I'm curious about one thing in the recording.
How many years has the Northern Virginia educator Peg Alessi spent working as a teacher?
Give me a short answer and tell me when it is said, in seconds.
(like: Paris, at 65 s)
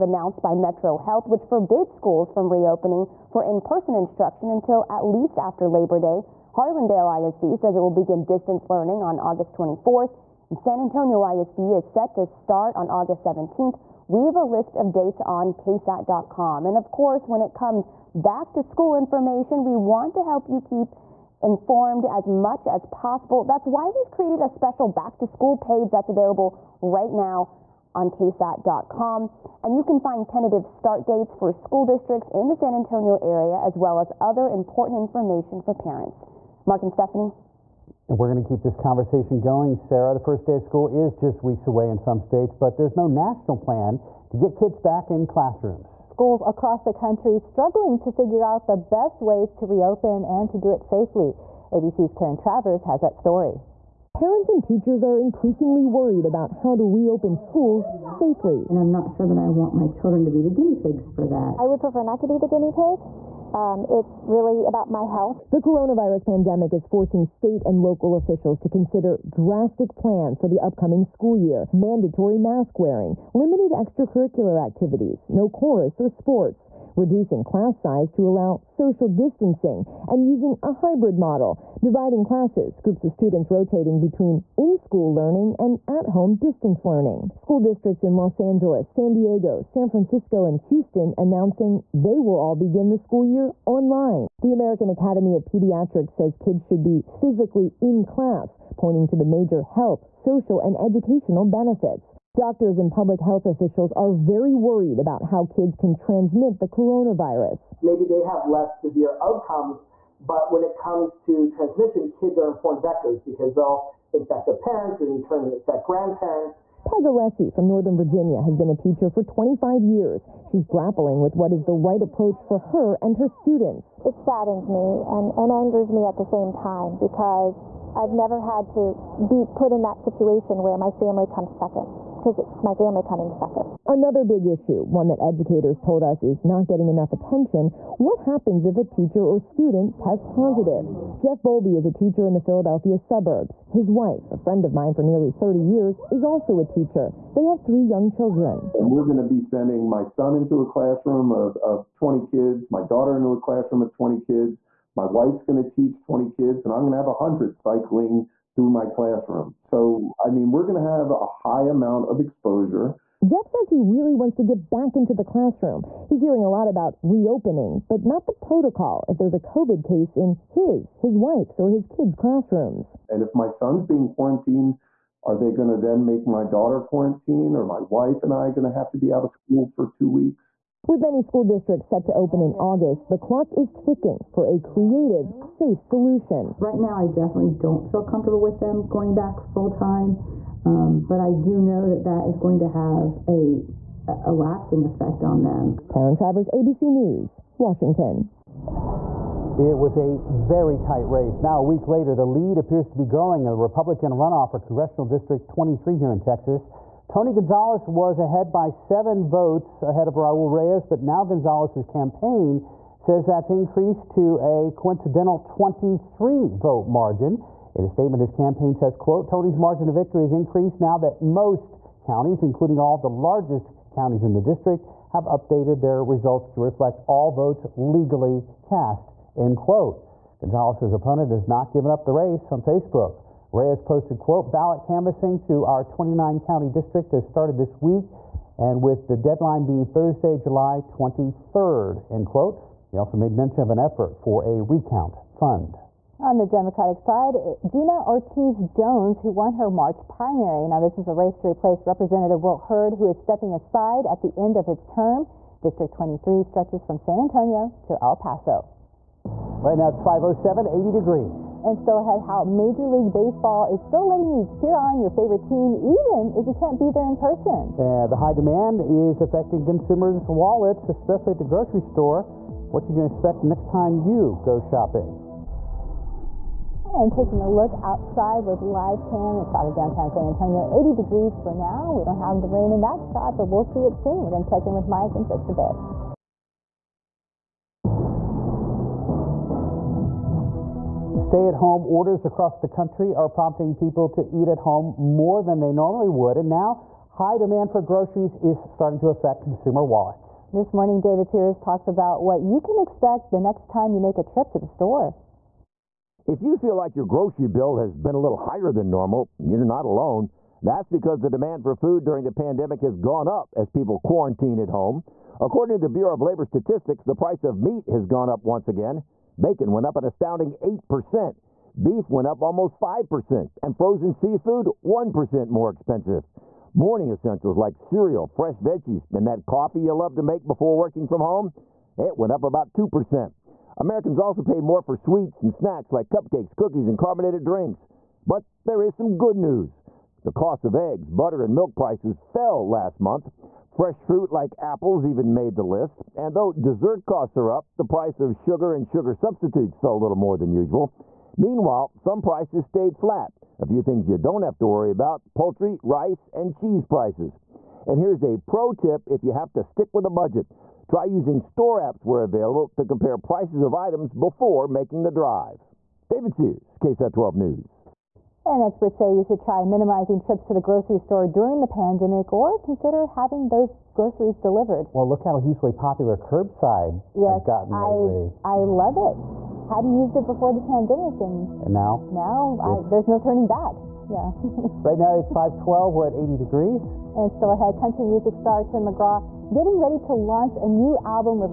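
25 years, at 119 s.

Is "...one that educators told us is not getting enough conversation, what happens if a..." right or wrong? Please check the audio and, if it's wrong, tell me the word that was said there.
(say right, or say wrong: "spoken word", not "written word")
wrong: "attention", not "conversation".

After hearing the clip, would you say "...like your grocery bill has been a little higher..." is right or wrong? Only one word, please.
right.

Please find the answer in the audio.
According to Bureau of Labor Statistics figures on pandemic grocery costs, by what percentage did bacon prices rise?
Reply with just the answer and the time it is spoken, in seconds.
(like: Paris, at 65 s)
8%, at 320 s.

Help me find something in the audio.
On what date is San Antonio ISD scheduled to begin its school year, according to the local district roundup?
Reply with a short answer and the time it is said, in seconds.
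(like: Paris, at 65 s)
August 17th, at 12 s.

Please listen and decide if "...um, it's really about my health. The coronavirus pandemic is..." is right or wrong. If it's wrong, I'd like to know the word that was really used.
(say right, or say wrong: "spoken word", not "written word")
right.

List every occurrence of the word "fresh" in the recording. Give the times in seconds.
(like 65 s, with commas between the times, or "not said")
328 s, 343 s.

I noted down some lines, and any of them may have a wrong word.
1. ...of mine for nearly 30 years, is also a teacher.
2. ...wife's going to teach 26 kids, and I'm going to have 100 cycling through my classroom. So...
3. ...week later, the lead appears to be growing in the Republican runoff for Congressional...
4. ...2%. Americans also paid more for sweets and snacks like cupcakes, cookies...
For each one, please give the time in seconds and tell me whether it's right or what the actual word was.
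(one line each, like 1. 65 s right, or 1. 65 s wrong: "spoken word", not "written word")
1. 144 s right
2. 155 s wrong: "20", not "26"
3. 201 s right
4. 332 s right.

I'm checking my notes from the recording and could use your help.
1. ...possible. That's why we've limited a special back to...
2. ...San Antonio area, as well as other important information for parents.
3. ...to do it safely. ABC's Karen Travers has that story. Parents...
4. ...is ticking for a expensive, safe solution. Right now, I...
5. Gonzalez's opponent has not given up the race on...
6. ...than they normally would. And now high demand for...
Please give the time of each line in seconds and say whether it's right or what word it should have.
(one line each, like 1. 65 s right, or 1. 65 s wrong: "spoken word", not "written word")
1. 22 s wrong: "created", not "limited"
2. 32 s right
3. 50 s right
4. 183 s wrong: "creative", not "expensive"
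5. 230 s right
6. 295 s right.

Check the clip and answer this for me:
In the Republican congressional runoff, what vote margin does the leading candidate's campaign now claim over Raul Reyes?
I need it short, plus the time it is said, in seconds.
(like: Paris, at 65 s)
23 votes, at 215 s.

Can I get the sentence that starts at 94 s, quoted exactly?
The American Academy of Pediatrics says kids should be physically in class, pointing to the major health, social, and educational benefits.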